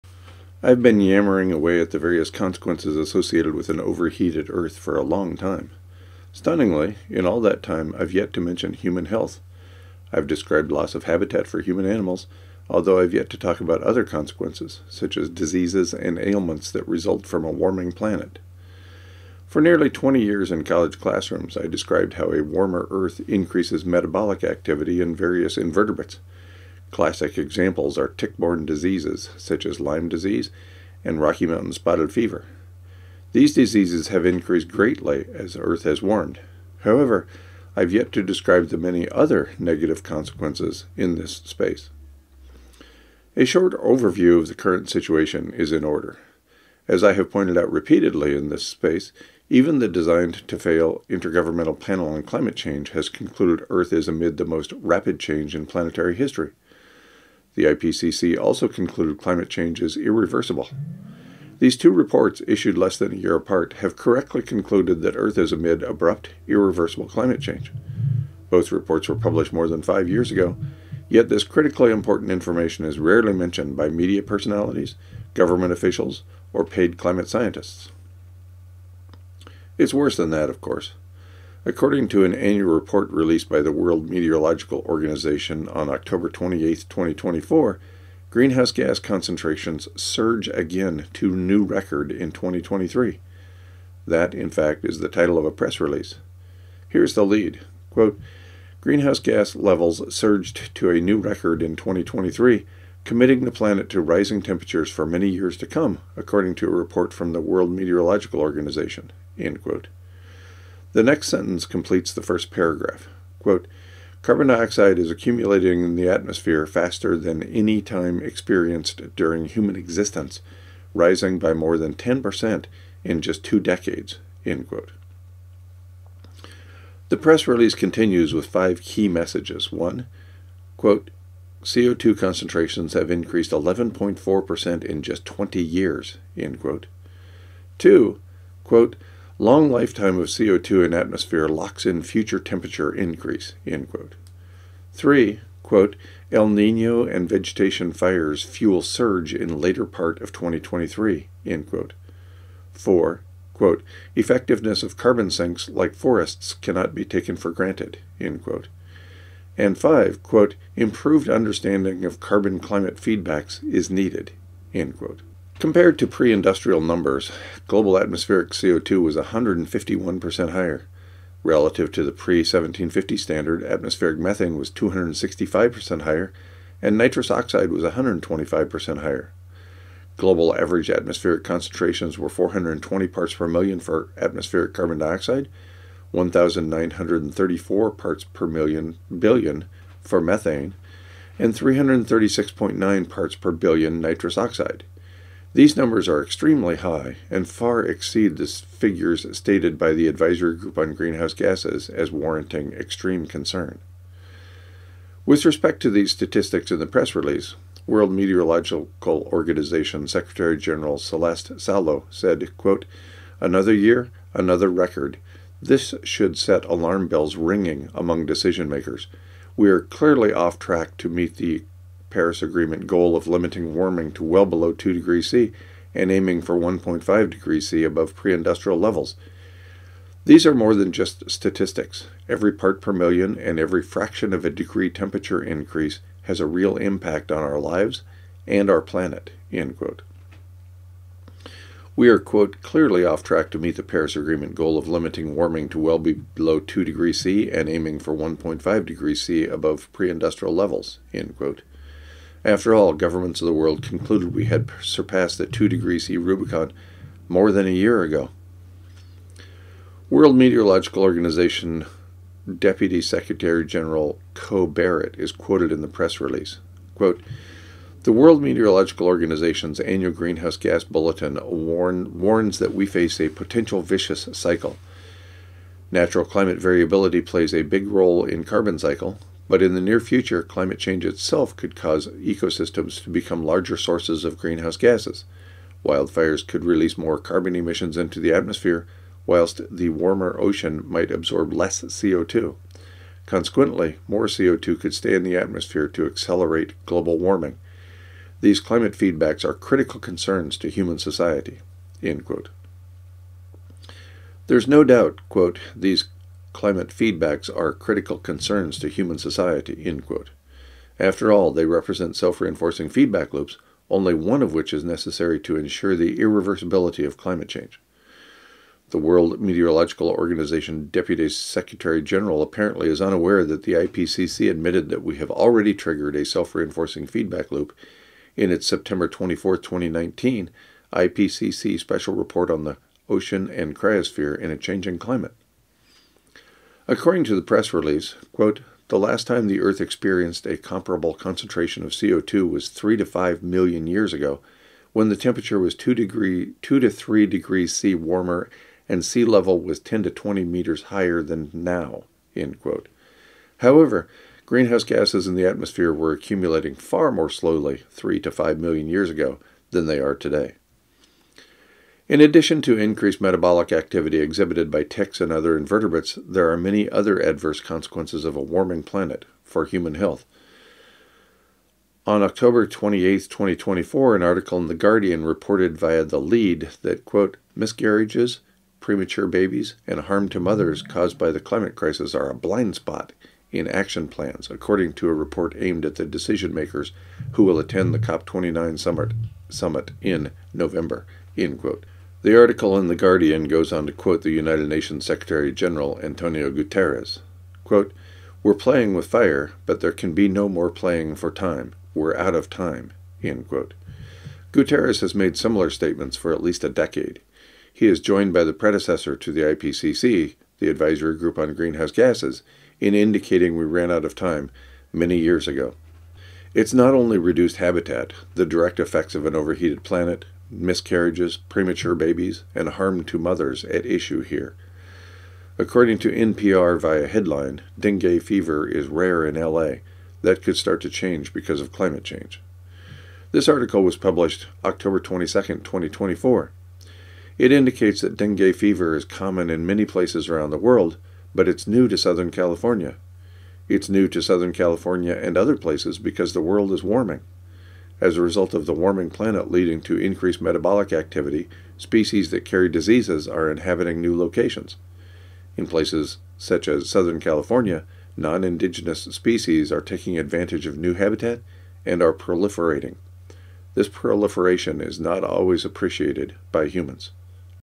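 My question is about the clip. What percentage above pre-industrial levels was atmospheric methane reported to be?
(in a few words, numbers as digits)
265%.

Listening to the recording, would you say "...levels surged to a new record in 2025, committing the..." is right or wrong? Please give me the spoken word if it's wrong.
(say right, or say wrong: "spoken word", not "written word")
wrong: "2023", not "2025".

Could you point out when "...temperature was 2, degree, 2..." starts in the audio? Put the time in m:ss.
5:45.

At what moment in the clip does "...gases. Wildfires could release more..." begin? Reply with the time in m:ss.
4:44.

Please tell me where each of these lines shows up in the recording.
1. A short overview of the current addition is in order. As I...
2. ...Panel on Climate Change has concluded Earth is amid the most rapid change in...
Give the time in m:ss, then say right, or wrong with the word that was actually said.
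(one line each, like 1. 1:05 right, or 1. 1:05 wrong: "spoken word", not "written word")
1. 0:43 wrong: "situation", not "addition"
2. 0:51 right.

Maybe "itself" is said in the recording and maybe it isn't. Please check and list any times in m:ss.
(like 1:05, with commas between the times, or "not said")
4:41.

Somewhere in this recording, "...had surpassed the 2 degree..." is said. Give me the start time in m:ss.
4:14.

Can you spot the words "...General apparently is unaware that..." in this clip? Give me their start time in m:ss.
5:22.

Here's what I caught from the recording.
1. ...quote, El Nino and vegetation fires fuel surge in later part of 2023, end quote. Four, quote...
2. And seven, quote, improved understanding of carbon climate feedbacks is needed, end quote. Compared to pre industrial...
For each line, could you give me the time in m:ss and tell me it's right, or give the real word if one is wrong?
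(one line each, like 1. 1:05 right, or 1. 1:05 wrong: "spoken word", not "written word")
1. 2:25 right
2. 2:39 wrong: "five", not "seven".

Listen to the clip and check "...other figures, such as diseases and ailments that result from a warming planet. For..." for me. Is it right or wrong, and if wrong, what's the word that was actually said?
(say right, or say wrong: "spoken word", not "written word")
wrong: "consequences", not "figures".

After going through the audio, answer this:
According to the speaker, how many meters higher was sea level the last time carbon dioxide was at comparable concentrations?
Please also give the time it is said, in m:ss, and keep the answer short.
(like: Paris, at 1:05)
10 to 20 meters, at 5:49.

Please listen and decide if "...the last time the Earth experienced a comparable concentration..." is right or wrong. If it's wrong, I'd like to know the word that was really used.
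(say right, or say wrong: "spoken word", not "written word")
right.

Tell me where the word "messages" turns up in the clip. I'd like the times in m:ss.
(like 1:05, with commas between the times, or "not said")
2:09.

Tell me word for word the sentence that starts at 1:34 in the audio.
That, in fact, is the title of a press release.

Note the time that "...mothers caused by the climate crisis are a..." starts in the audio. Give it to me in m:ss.
6:20.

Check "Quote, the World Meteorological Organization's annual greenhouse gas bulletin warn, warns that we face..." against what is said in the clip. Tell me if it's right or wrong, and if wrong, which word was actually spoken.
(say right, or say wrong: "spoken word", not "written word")
right.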